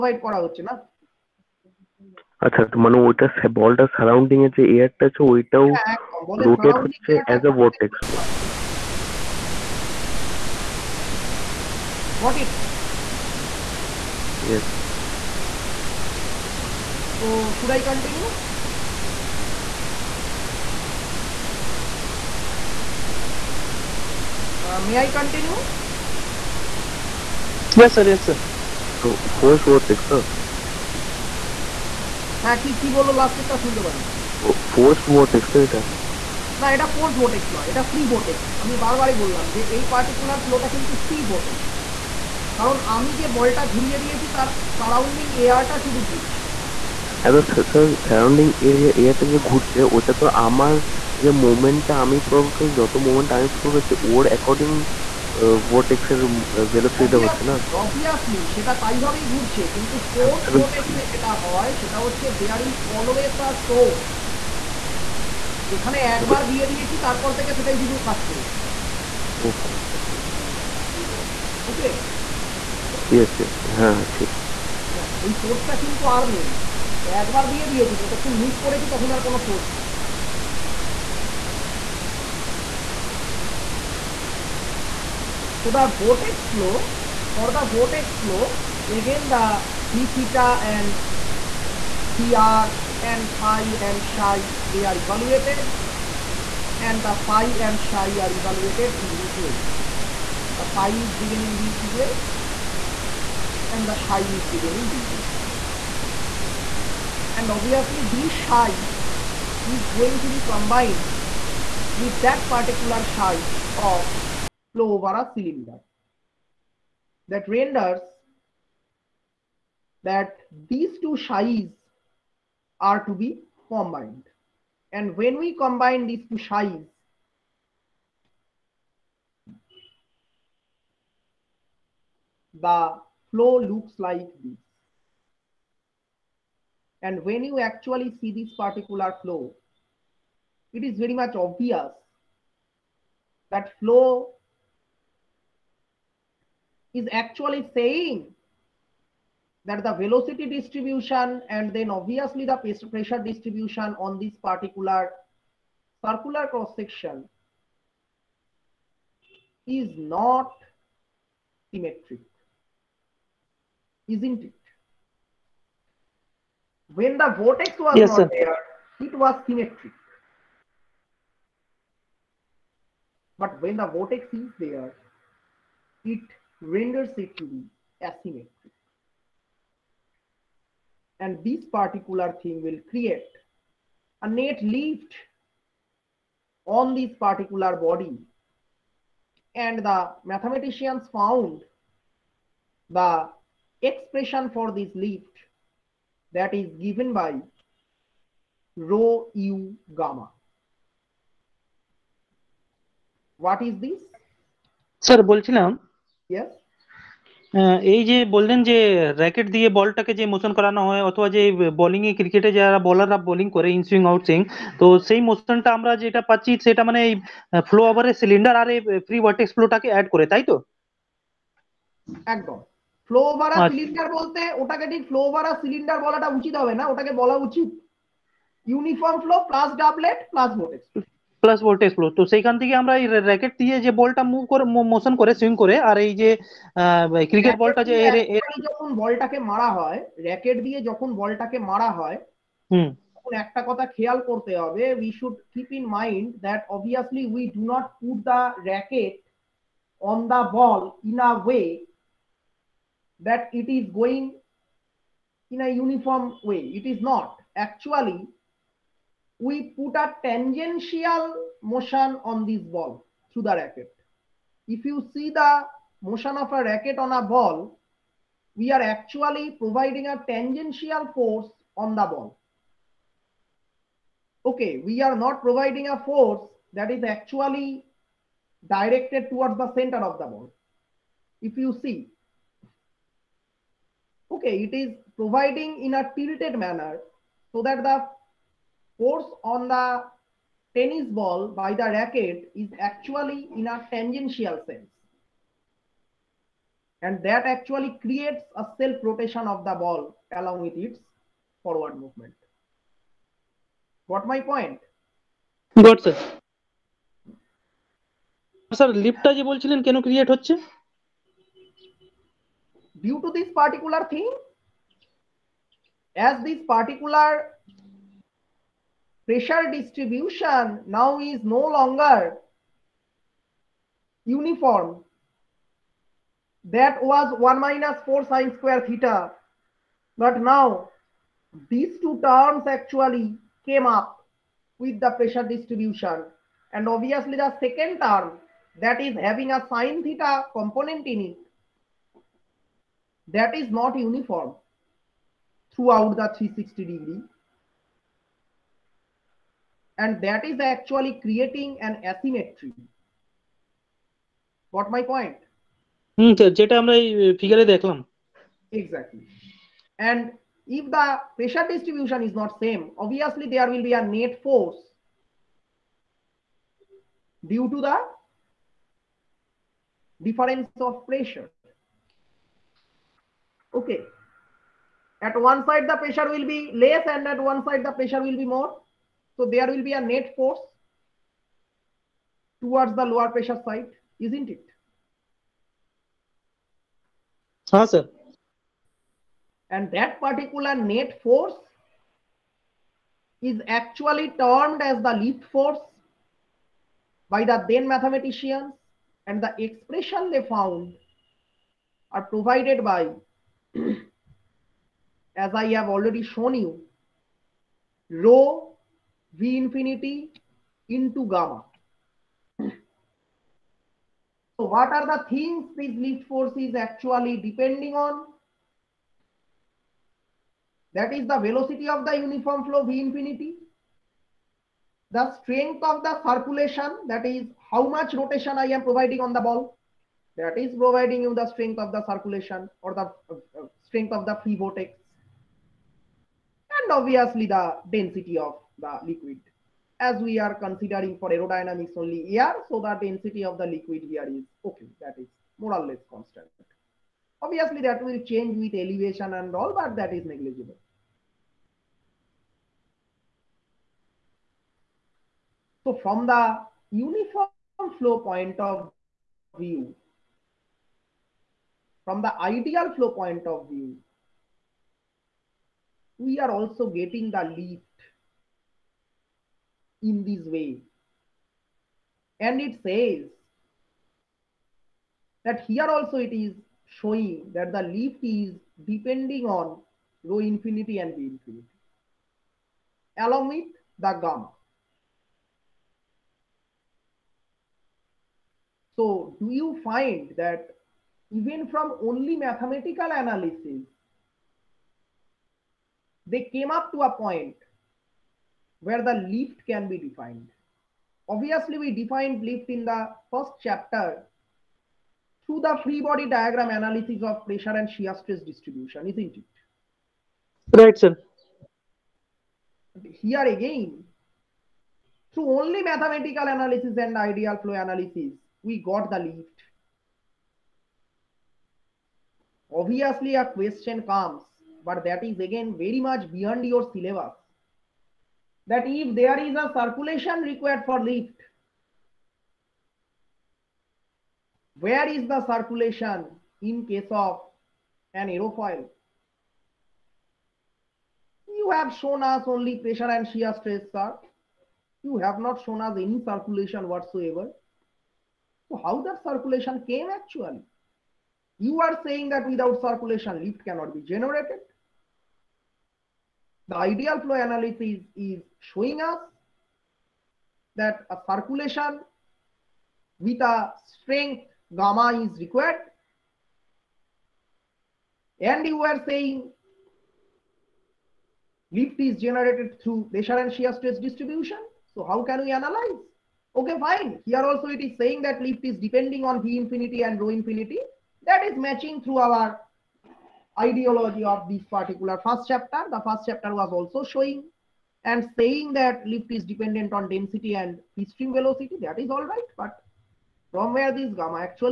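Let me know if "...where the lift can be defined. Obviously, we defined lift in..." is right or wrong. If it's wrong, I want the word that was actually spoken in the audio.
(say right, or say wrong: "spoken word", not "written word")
right.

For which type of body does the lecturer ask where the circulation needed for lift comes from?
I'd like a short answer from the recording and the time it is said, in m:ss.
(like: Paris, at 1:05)
Aerofoil, at 8:58.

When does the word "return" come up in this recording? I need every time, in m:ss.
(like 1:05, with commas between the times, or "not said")
not said.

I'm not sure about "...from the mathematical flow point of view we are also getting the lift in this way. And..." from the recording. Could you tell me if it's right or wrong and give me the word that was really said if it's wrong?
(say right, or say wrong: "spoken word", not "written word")
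wrong: "ideal", not "mathematical".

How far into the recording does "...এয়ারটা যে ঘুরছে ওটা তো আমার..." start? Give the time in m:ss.
0:49.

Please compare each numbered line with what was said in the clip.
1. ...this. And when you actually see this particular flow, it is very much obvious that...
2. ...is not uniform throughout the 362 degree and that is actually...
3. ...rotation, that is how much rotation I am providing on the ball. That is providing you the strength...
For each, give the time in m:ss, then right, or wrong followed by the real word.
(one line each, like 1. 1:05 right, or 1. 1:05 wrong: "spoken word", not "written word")
1. 2:14 right
2. 5:43 wrong: "360", not "362"
3. 7:06 wrong: "circulation", not "rotation".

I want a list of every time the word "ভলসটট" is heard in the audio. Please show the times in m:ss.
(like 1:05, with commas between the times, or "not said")
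0:56.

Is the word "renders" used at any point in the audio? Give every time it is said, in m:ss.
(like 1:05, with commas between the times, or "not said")
1:57, 2:56.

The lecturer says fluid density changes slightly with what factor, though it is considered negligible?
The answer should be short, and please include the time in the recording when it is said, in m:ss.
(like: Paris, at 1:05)
Elevation, at 7:28.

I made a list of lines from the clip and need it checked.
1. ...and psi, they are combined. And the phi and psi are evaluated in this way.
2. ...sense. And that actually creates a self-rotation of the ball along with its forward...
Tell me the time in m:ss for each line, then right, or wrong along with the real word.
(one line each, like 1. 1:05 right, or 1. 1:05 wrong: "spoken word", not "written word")
1. 1:33 wrong: "evaluated", not "combined"
2. 4:54 right.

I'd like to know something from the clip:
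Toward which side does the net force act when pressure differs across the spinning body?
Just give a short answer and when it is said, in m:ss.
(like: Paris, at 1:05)
Lower pressure side, at 6:23.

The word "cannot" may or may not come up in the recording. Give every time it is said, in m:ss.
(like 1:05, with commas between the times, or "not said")
9:13.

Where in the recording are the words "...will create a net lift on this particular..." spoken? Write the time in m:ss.
3:02.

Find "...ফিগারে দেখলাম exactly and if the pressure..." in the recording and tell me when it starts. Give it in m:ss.
5:57.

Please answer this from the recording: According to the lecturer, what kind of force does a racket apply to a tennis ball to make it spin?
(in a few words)
Tangential force.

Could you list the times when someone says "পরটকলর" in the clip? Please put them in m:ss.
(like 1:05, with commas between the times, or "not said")
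0:39.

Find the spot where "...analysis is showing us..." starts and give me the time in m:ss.
9:17.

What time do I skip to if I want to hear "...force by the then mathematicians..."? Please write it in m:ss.
6:35.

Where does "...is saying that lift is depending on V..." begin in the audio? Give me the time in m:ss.
9:37.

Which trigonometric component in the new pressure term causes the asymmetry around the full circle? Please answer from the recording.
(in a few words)
sine theta.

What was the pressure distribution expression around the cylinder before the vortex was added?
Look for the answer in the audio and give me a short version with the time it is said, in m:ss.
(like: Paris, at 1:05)
1 minus 4 sine squared theta, at 5:27.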